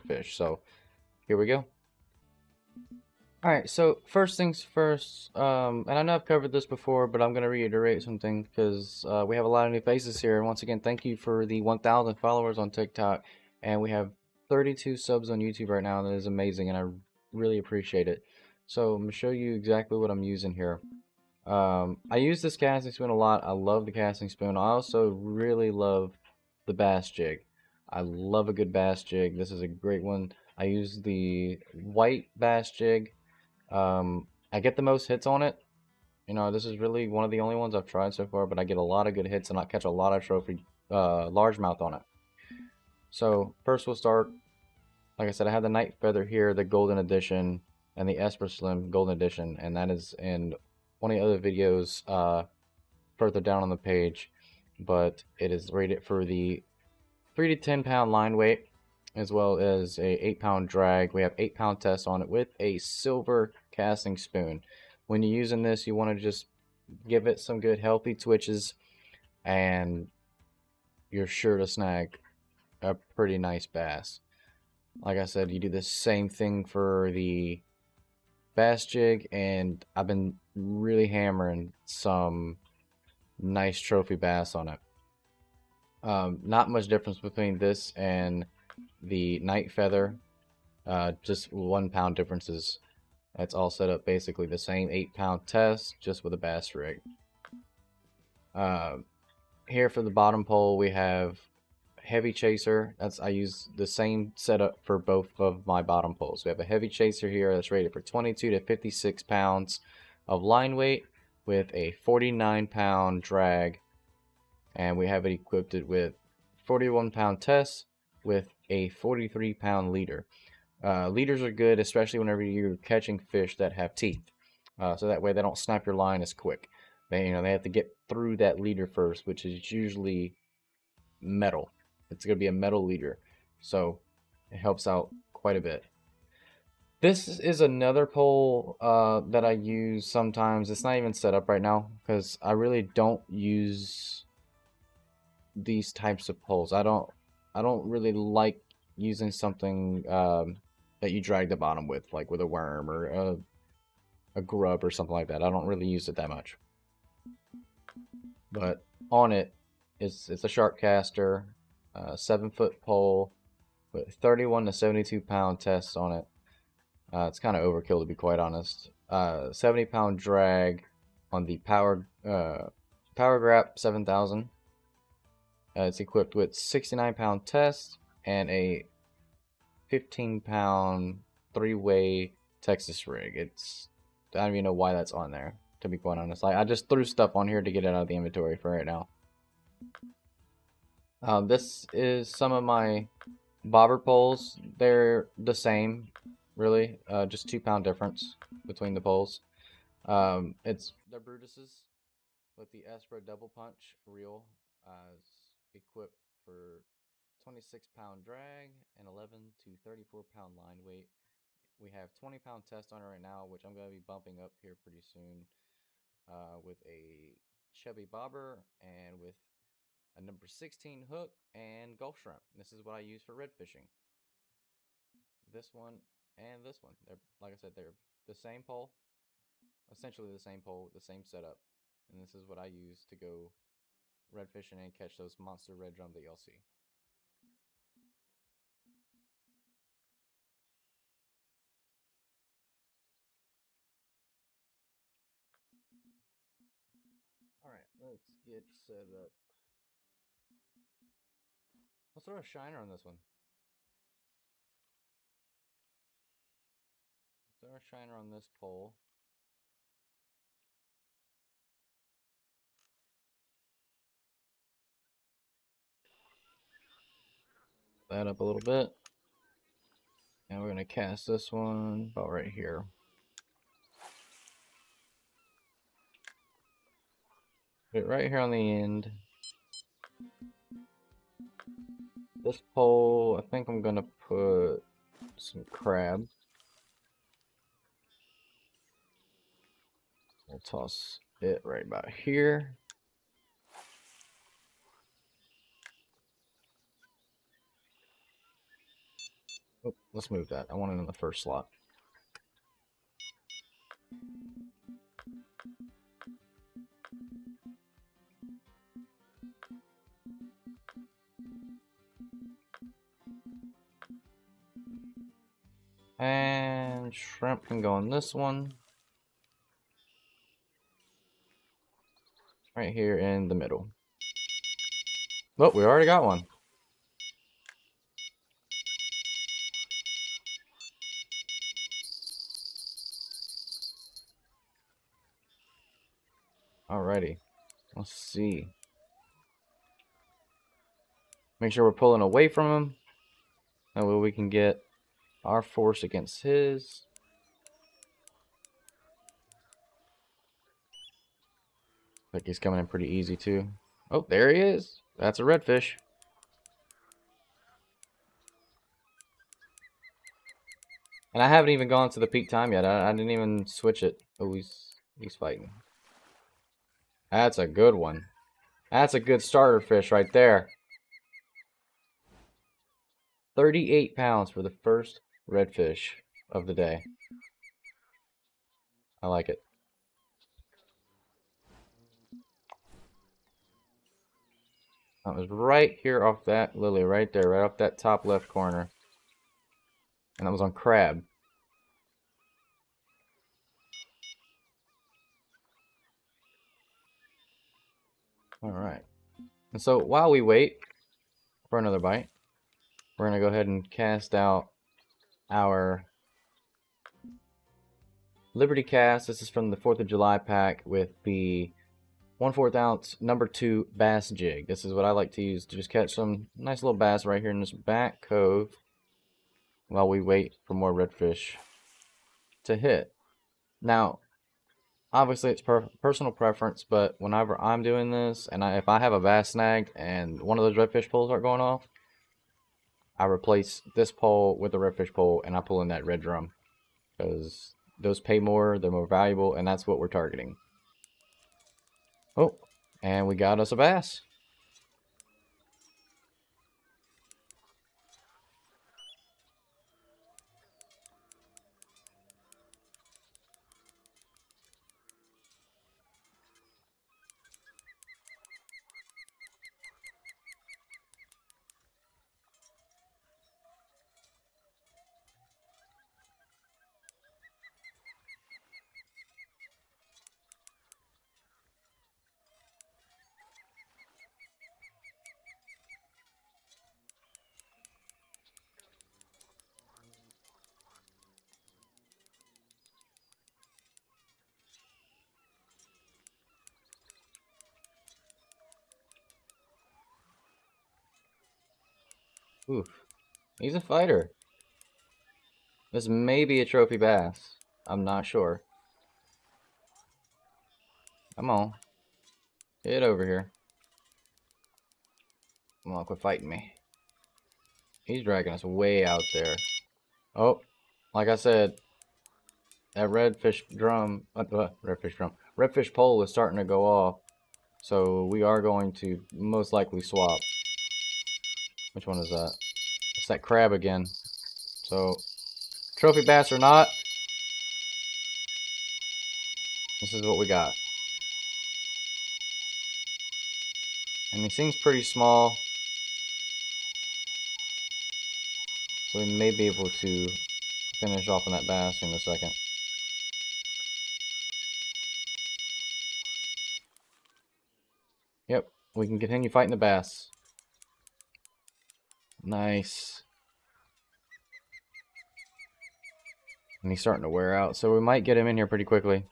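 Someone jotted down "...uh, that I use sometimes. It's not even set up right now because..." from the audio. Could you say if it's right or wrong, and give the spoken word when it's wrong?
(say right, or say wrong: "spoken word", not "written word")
right.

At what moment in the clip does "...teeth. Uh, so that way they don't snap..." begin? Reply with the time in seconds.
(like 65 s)
123 s.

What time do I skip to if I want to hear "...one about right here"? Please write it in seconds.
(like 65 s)
271 s.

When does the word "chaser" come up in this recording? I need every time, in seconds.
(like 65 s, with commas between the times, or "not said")
102 s, 106 s.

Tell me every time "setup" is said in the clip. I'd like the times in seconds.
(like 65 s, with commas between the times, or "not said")
104 s, 231 s.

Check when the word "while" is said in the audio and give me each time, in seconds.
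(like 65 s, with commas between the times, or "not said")
399 s, 419 s.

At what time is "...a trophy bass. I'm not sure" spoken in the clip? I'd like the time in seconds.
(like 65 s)
496 s.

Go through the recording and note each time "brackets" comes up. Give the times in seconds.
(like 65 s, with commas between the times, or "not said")
not said.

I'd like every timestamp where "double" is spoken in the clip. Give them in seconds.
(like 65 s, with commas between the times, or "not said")
203 s.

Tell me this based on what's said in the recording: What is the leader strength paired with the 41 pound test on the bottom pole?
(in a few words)
43 pounds.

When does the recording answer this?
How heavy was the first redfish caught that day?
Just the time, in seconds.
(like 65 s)
373 s.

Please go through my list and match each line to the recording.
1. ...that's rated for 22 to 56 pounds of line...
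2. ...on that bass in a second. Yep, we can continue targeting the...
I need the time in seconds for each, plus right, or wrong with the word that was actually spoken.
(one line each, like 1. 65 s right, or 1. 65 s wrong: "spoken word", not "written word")
1. 107 s right
2. 541 s wrong: "fighting", not "targeting".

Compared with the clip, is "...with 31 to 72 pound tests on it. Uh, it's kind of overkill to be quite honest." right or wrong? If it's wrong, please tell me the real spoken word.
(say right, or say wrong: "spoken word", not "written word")
right.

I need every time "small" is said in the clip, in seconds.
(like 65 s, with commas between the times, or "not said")
535 s.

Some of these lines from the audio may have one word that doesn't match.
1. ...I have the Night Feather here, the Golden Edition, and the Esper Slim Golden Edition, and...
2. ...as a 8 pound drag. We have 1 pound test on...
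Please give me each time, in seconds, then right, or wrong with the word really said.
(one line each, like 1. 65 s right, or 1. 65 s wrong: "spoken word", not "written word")
1. 45 s right
2. 59 s wrong: "8", not "1".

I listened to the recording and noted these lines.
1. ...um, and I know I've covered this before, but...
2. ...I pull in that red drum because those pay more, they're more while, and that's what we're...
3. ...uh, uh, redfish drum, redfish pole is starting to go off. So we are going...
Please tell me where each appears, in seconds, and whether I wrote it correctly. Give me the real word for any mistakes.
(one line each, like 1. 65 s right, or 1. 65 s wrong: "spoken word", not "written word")
1. 5 s right
2. 435 s wrong: "valuable", not "while"
3. 514 s right.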